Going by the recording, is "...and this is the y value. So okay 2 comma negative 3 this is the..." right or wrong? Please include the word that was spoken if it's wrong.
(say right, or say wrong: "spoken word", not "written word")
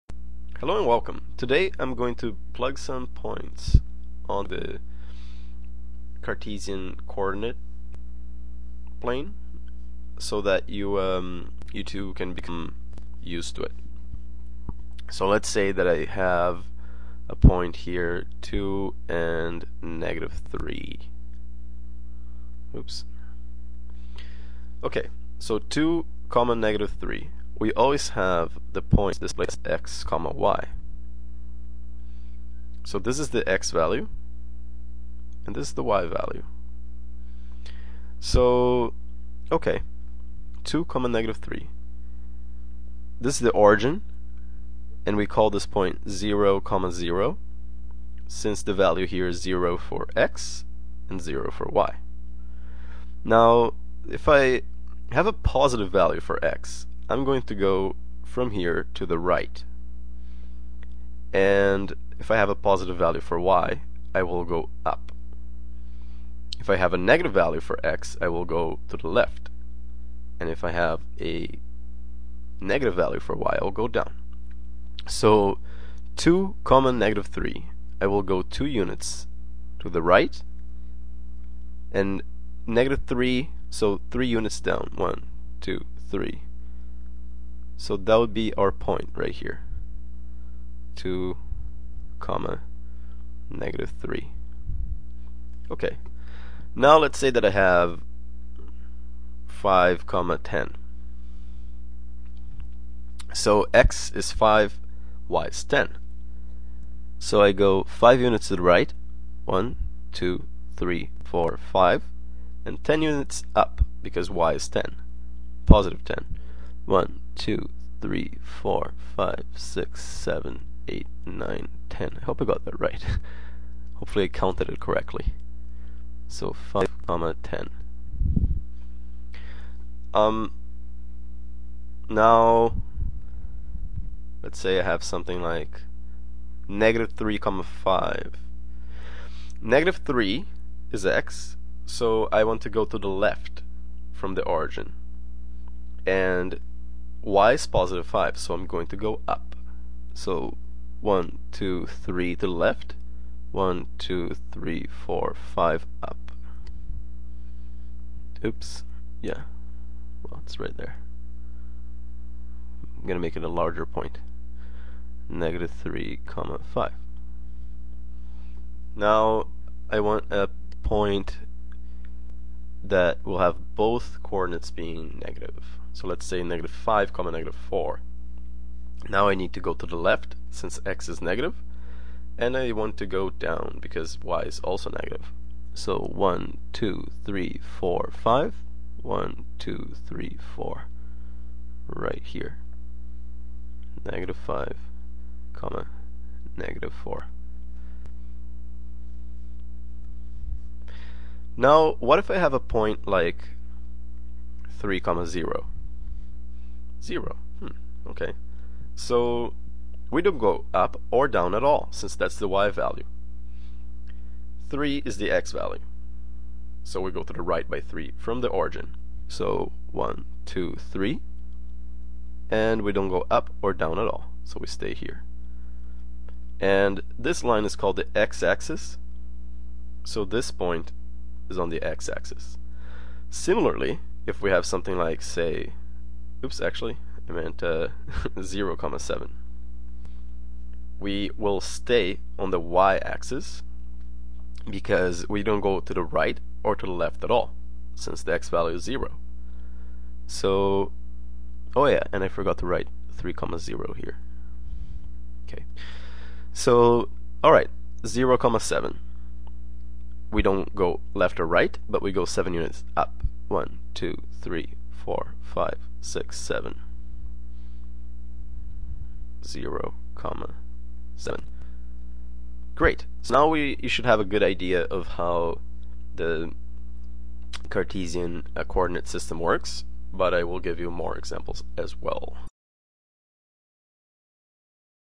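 right.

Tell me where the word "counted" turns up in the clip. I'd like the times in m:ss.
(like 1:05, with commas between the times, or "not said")
2:04.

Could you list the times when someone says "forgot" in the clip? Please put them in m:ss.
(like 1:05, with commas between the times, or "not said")
4:12.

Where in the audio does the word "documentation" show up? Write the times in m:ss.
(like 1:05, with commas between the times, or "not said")
not said.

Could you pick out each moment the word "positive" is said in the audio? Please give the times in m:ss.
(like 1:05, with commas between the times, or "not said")
0:55, 1:02, 1:55, 2:27.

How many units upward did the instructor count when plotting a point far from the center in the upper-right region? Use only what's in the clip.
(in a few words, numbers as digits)
10.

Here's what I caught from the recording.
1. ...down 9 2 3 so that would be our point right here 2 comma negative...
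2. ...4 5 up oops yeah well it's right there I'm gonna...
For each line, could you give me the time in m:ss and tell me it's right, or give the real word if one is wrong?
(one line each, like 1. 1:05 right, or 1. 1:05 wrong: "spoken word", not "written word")
1. 1:24 wrong: "1", not "9"
2. 2:35 right.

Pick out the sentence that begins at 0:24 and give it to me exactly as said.
Okay, so 2 comma negative 3 we always have the points displayed as x comma y.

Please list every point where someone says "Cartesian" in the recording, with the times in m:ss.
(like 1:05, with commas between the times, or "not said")
0:06, 4:37.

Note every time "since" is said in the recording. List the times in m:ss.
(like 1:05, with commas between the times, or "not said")
0:48, 3:00, 3:31, 4:07.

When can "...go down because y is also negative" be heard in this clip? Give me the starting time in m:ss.
3:03.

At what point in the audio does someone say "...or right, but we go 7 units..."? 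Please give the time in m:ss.
4:21.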